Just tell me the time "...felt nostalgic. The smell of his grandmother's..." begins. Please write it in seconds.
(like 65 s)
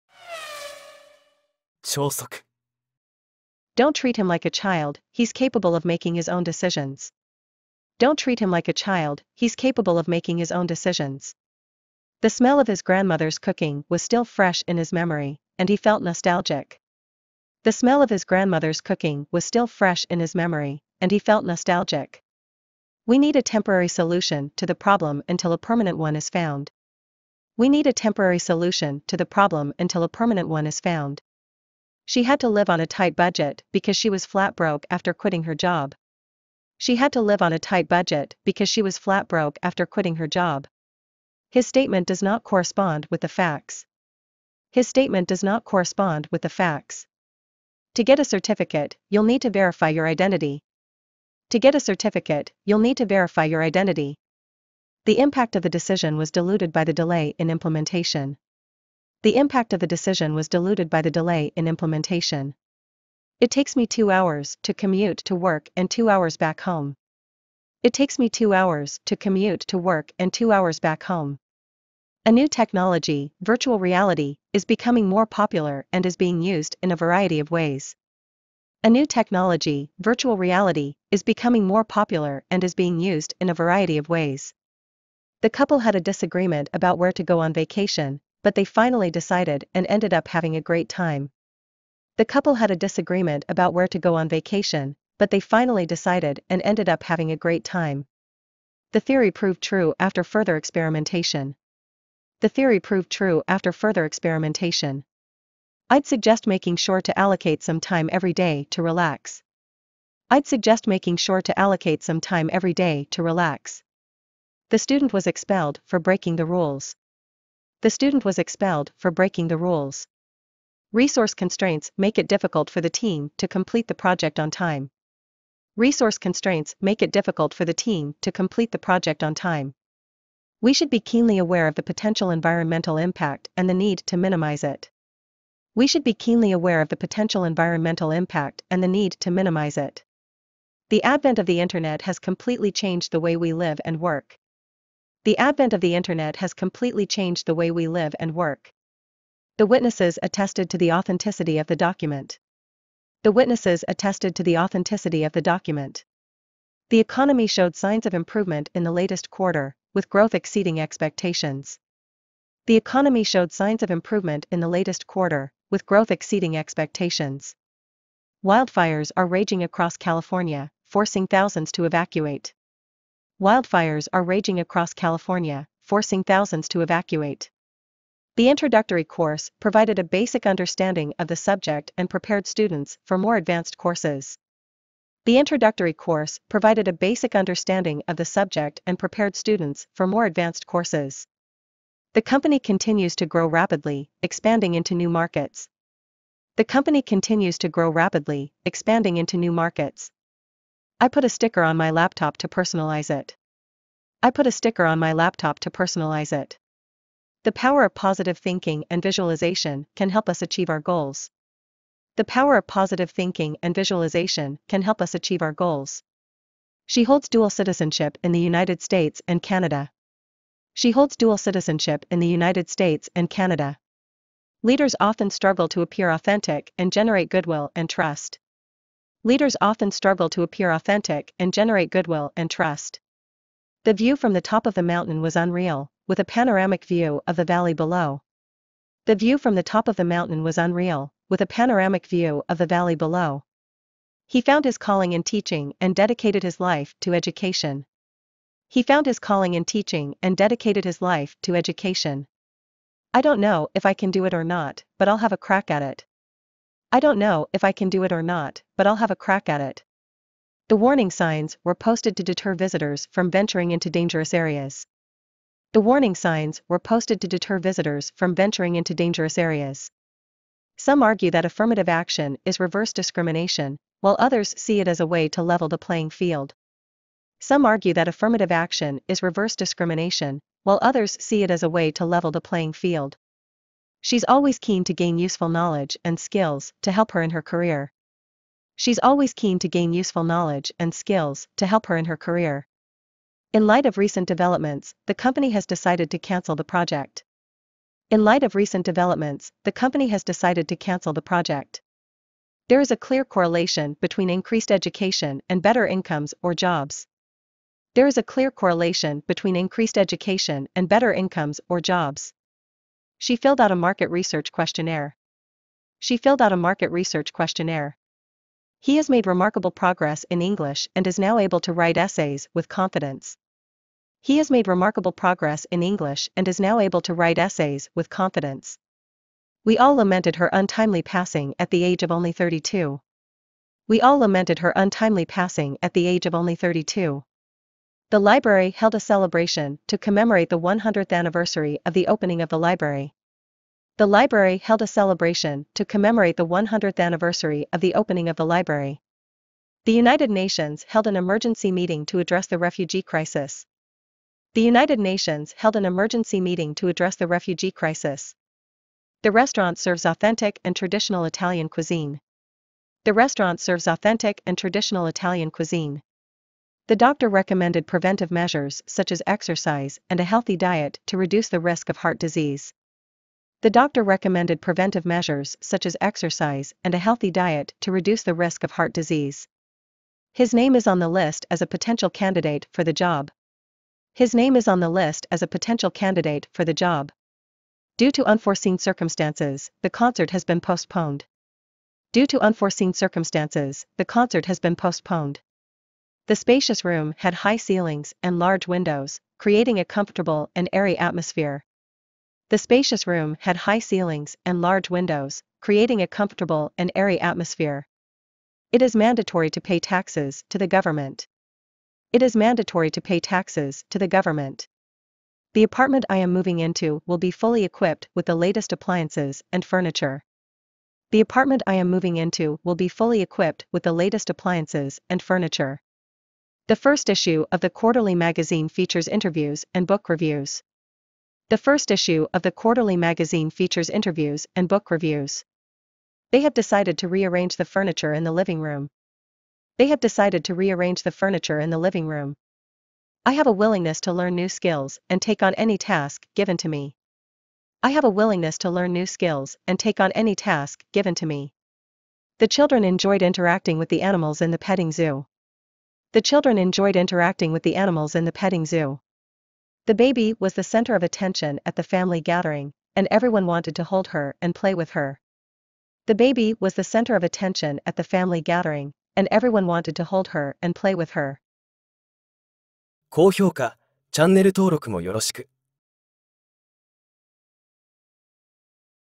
15 s.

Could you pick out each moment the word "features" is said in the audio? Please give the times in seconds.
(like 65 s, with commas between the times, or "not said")
428 s, 433 s.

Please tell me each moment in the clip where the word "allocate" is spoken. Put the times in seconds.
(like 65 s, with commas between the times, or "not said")
107 s, 111 s.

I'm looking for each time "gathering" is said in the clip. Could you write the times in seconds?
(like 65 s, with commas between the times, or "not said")
462 s, 468 s.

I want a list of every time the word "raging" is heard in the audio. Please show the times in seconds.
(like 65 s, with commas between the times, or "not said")
169 s, 174 s.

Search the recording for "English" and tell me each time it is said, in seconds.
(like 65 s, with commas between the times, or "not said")
320 s, 325 s.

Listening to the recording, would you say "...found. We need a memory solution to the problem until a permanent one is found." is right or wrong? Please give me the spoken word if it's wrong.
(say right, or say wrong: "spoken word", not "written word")
wrong: "temporary", not "memory".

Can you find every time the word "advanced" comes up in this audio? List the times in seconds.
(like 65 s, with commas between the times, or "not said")
183 s, 190 s.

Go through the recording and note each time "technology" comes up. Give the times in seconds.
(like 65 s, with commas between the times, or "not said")
72 s, 79 s.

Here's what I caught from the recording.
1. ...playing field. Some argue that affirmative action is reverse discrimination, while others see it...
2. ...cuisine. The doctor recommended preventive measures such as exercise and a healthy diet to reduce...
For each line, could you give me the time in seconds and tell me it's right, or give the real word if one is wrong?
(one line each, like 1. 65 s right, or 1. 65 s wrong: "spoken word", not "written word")
1. 275 s right
2. 365 s right.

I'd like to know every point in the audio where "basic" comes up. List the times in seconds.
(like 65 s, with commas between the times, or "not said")
180 s, 186 s.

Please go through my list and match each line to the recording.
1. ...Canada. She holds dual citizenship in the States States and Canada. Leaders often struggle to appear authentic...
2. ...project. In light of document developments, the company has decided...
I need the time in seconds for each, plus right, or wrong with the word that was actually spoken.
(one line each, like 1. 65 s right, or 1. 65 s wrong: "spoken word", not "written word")
1. 219 s wrong: "United", not "States"
2. 296 s wrong: "recent", not "document".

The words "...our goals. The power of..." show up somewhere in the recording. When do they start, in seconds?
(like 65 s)
210 s.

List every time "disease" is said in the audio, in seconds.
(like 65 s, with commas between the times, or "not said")
372 s, 378 s.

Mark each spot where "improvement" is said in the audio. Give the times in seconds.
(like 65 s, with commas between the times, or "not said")
158 s, 163 s.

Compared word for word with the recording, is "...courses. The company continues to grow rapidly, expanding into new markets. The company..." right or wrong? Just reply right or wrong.
right.